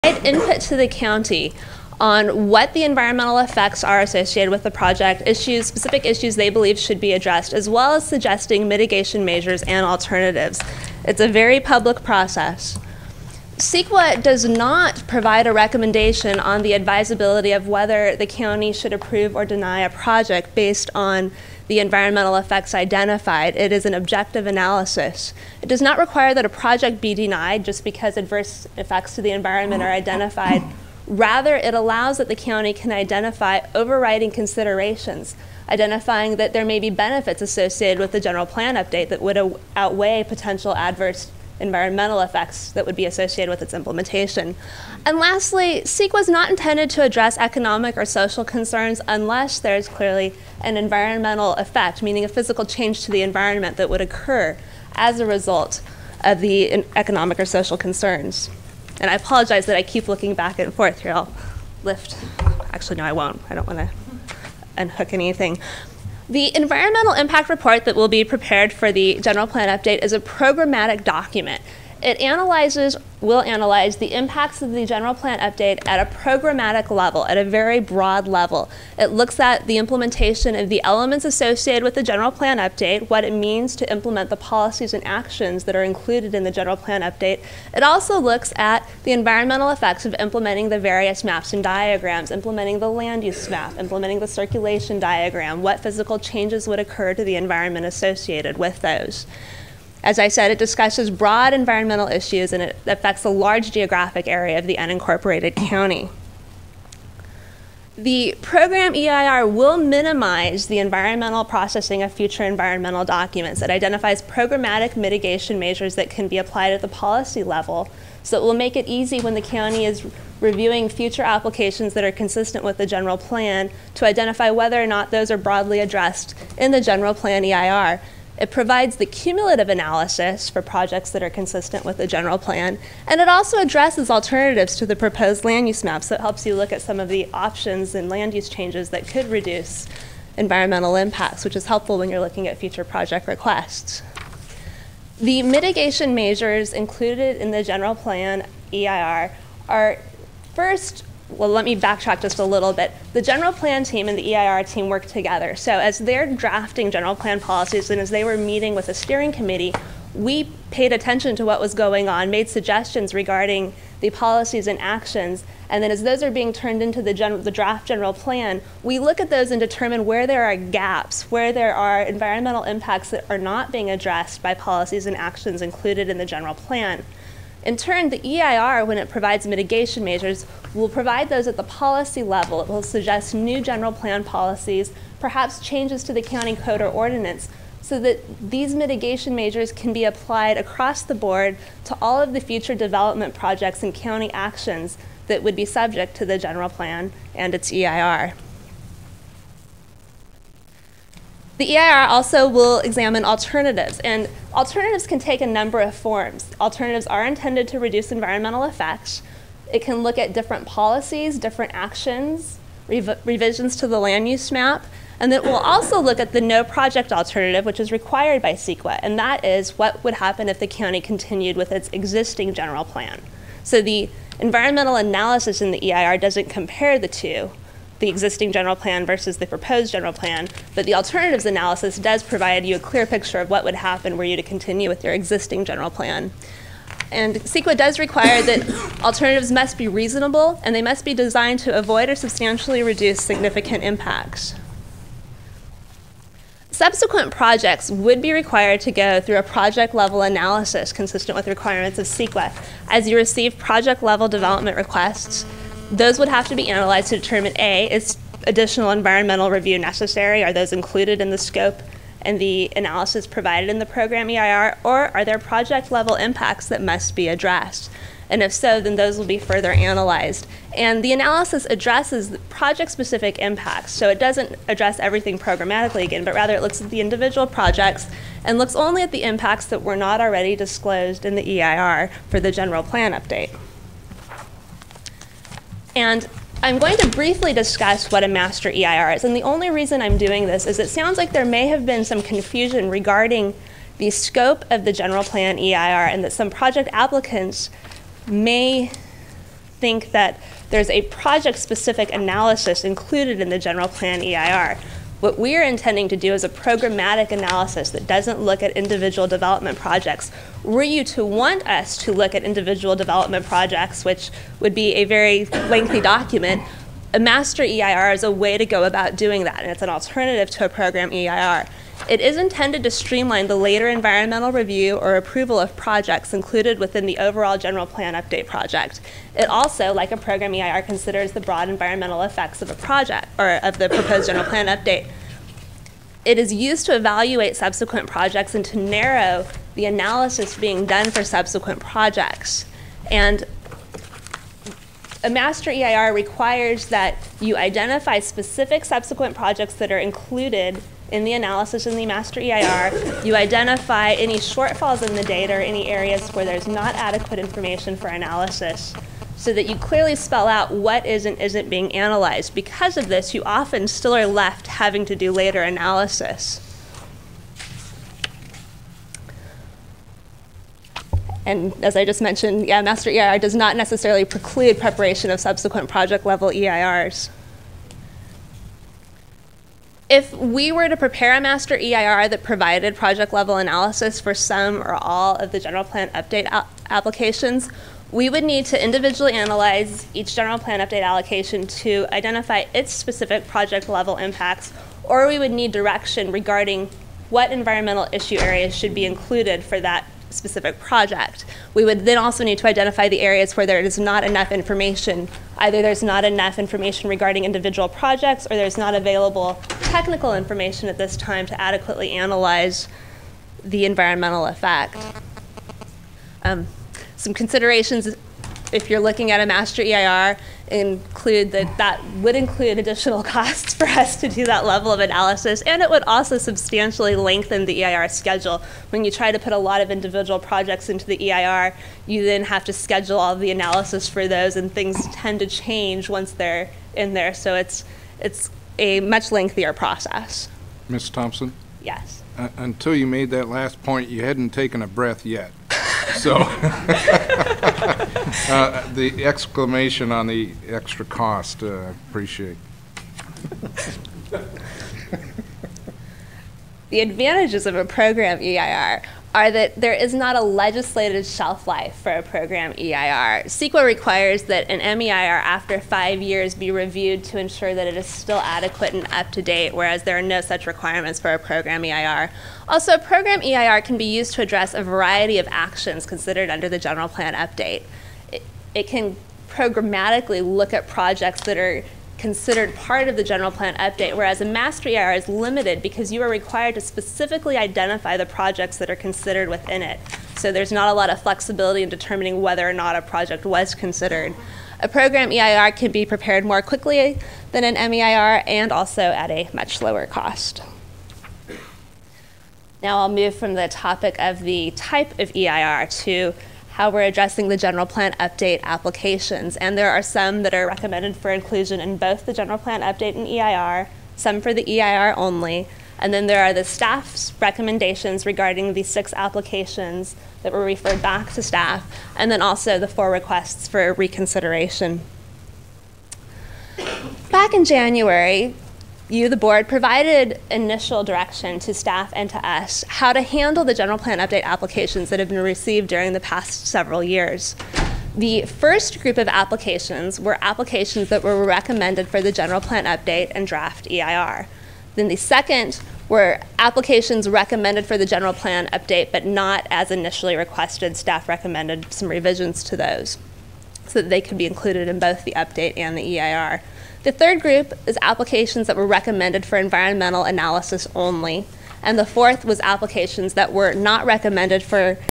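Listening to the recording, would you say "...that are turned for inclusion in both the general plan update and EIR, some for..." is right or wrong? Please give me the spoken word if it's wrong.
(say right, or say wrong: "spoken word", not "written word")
wrong: "recommended", not "turned".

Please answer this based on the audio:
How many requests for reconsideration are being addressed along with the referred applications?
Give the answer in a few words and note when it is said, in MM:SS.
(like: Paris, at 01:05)
4, at 08:42.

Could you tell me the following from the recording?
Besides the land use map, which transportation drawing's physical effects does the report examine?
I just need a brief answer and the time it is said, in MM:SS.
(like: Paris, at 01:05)
circulation diagram, at 01:34.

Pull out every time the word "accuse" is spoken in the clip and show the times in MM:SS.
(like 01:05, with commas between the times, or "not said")
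not said.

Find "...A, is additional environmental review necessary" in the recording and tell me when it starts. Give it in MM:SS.
04:17.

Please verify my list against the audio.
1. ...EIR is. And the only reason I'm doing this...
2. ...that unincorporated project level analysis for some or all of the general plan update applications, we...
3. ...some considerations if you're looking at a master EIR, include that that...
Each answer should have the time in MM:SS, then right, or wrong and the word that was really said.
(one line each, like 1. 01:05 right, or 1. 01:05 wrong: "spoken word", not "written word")
1. 04:48 right
2. 06:22 wrong: "provided", not "unincorporated"
3. 06:57 right.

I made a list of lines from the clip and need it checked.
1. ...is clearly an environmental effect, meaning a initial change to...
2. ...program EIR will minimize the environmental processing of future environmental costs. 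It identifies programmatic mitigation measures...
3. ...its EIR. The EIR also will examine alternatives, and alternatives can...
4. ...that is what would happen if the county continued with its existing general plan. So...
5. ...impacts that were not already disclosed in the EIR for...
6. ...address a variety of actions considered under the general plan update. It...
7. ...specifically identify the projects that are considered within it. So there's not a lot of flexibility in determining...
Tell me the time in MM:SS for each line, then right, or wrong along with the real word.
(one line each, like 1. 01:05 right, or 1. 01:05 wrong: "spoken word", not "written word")
1. 00:49 wrong: "physical", not "initial"
2. 01:48 wrong: "documents", not "costs"
3. 03:17 right
4. 03:39 right
5. 04:39 right
6. 07:54 right
7. 08:06 right.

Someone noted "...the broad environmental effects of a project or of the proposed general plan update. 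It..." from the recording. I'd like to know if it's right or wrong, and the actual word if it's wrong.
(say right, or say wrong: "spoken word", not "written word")
right.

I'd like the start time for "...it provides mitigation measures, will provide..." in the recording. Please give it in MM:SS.
02:58.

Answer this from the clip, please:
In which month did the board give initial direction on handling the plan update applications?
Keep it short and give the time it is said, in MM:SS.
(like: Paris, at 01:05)
January, at 08:47.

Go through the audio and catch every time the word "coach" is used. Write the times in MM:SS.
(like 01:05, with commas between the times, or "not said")
not said.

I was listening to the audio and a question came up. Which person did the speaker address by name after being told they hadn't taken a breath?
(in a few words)
Ms. Thompson.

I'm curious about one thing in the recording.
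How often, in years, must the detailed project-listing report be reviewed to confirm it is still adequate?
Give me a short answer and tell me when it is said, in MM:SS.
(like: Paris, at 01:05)
5, at 07:45.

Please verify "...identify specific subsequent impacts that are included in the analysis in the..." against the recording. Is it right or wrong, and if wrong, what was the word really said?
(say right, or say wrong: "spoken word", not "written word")
wrong: "projects", not "impacts".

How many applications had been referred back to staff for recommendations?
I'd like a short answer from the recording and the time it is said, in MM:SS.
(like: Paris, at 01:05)
6, at 08:38.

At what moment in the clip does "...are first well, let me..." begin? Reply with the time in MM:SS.
02:29.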